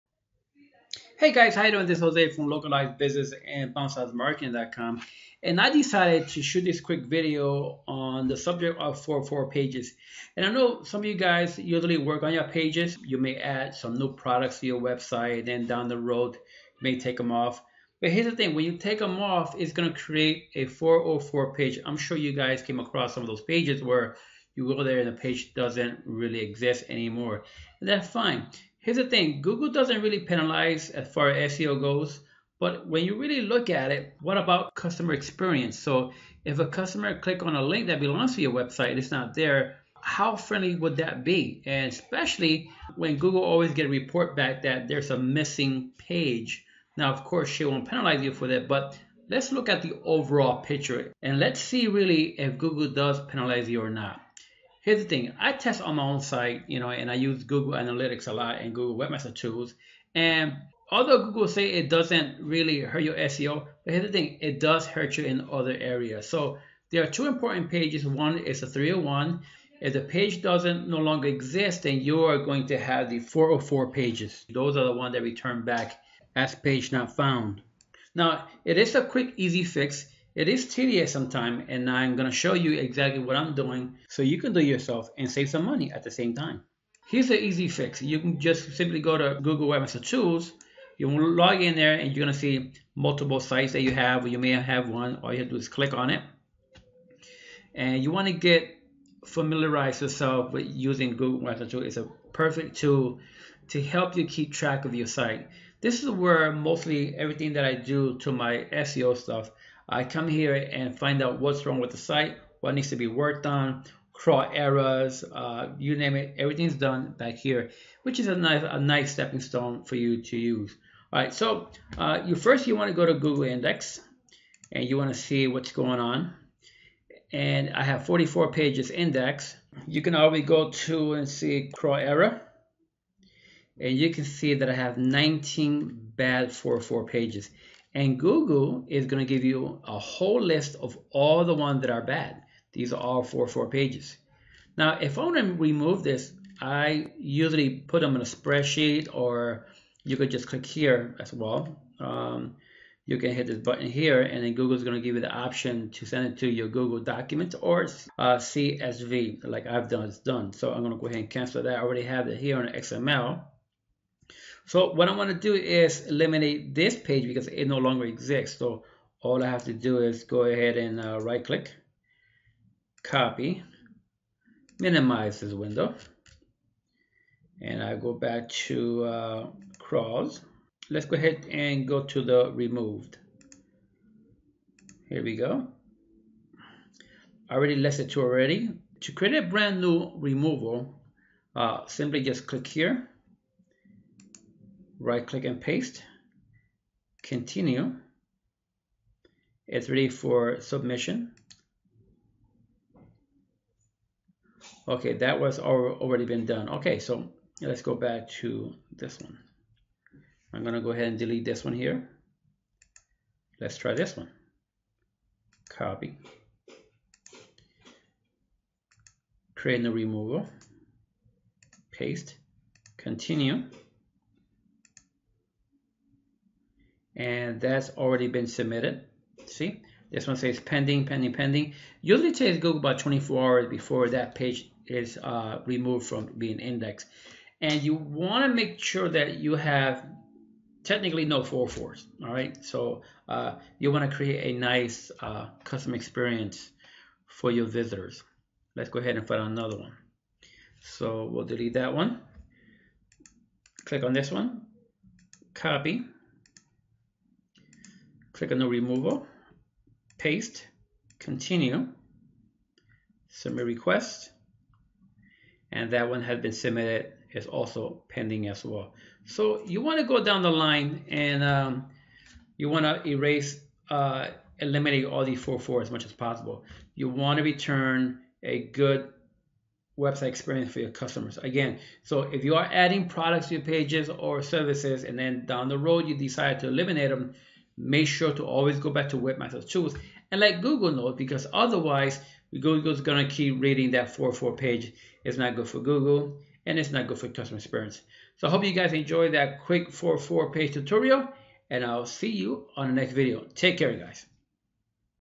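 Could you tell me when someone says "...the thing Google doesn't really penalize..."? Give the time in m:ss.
0:28.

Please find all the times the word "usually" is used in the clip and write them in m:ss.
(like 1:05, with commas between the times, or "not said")
0:11, 2:27, 3:52.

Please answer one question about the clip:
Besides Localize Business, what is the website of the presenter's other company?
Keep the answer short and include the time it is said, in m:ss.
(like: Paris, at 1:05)
BounceHouseMarketing.com, at 0:03.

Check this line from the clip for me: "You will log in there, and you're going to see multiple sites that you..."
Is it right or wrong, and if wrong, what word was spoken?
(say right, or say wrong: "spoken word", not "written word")
right.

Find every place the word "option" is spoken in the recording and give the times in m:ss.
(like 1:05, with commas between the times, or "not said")
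2:35.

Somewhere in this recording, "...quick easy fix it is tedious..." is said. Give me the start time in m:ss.
1:19.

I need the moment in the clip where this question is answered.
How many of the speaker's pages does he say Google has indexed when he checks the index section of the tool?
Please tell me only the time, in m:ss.
2:08.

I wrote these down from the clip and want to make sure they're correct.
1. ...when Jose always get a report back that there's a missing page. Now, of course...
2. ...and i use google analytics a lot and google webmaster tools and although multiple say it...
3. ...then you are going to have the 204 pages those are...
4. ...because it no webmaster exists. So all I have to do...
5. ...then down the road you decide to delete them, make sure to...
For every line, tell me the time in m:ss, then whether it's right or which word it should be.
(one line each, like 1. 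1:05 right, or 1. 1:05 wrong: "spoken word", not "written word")
1. 0:42 wrong: "Google", not "Jose"
2. 0:56 wrong: "google", not "multiple"
3. 1:11 wrong: "404", not "204"
4. 2:47 wrong: "longer", not "webmaster"
5. 4:45 wrong: "eliminate", not "delete".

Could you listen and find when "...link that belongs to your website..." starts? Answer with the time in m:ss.
0:37.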